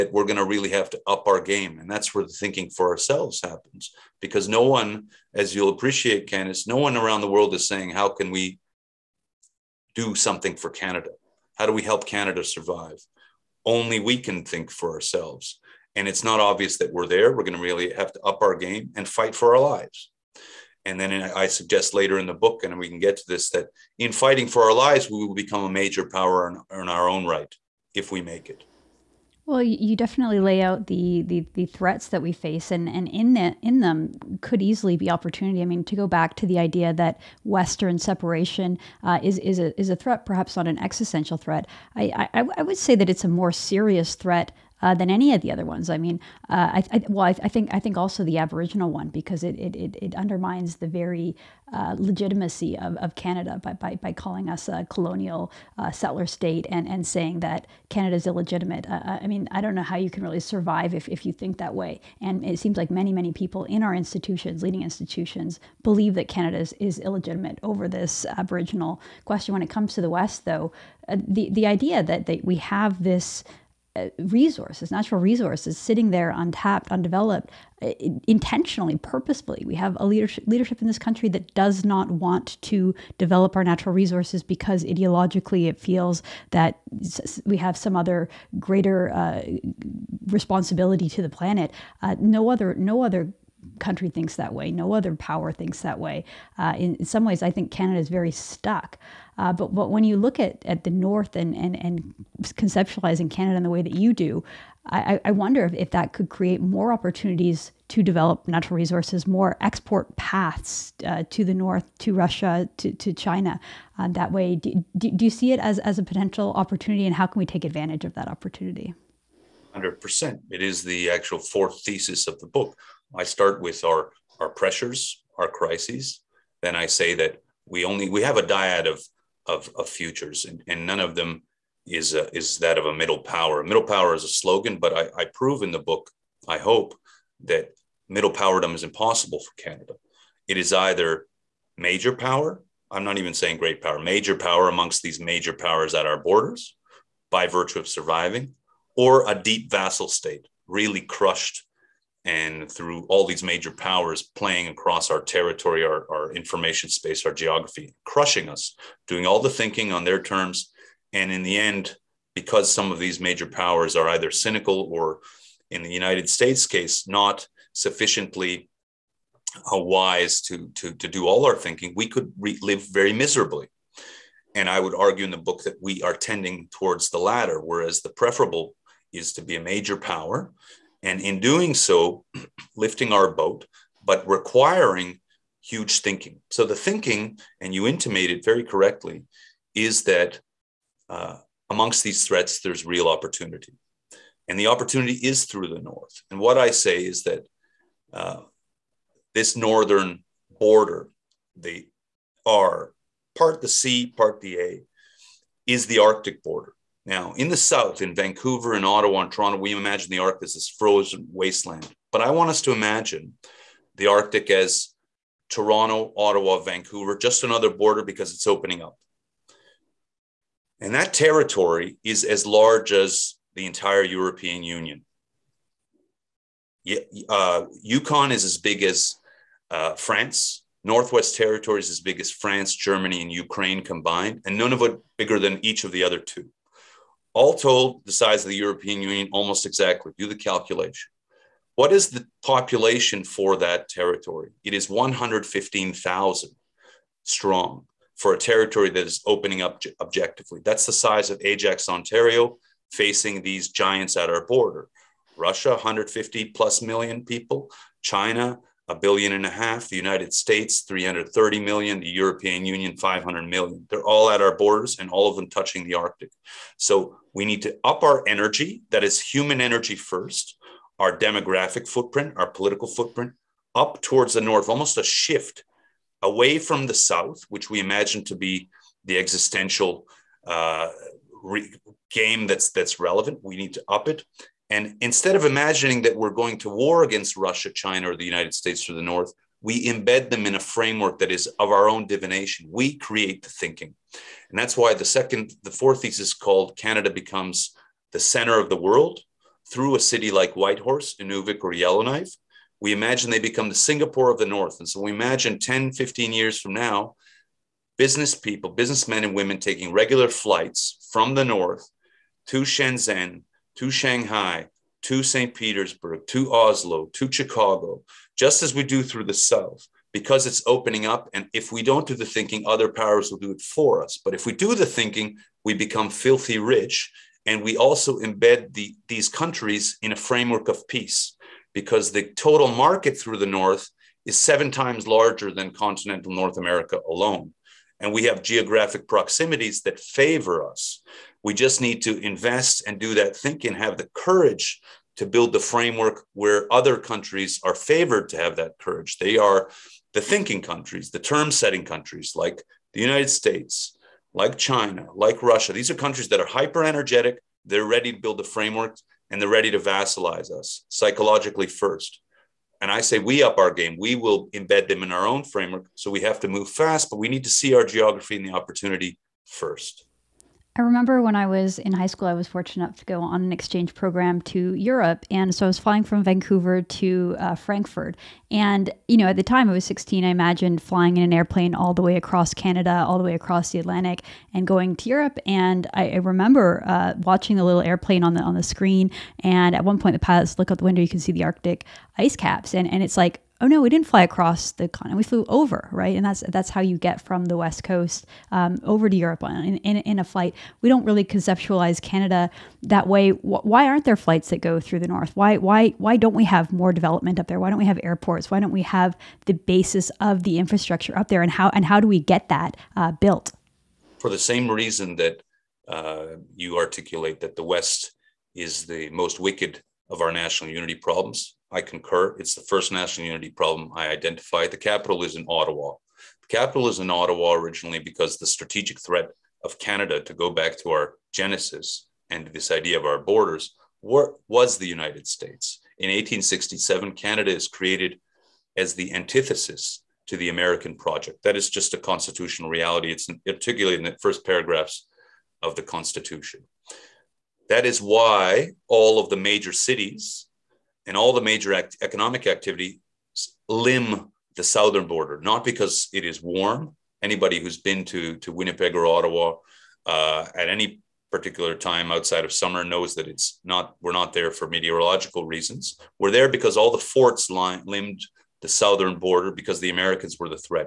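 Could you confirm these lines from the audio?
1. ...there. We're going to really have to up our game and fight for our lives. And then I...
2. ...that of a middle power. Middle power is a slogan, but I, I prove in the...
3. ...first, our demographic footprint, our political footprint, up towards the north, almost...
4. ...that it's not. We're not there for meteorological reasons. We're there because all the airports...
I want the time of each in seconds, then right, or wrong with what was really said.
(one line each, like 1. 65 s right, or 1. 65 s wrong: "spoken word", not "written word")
1. 17 s right
2. 132 s right
3. 269 s right
4. 463 s wrong: "forts", not "airports".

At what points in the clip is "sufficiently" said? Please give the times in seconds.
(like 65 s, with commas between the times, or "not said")
167 s.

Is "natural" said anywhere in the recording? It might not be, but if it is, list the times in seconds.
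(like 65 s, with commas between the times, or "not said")
74 s, 83 s, 108 s.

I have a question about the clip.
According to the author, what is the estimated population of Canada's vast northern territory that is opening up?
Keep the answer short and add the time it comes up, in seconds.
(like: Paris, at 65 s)
115,000, at 244 s.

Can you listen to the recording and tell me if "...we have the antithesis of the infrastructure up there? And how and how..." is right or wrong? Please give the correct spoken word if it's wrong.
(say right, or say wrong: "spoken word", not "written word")
wrong: "basis", not "antithesis".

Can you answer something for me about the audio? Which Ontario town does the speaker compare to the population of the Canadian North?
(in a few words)
Ajax.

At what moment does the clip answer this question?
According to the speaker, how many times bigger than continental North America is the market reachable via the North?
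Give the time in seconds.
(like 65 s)
334 s.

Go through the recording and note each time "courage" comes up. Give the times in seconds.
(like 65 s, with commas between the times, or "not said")
344 s, 348 s.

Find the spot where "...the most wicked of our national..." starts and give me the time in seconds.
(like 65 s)
418 s.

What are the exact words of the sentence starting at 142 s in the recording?
I'm not even saying great power.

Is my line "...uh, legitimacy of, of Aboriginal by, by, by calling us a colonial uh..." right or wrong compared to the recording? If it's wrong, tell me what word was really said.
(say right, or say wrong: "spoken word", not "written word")
wrong: "Canada", not "Aboriginal".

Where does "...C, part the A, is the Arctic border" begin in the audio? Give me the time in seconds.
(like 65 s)
203 s.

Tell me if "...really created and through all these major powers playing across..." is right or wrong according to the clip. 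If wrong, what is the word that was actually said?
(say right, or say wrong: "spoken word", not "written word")
wrong: "crushed", not "created".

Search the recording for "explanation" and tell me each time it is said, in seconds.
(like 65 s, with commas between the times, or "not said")
not said.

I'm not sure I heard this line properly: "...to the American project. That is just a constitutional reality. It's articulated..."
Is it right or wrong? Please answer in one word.
right.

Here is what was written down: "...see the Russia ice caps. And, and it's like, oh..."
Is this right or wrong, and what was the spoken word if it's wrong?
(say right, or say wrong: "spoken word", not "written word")
wrong: "Arctic", not "Russia".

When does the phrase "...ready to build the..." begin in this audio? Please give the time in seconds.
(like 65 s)
357 s.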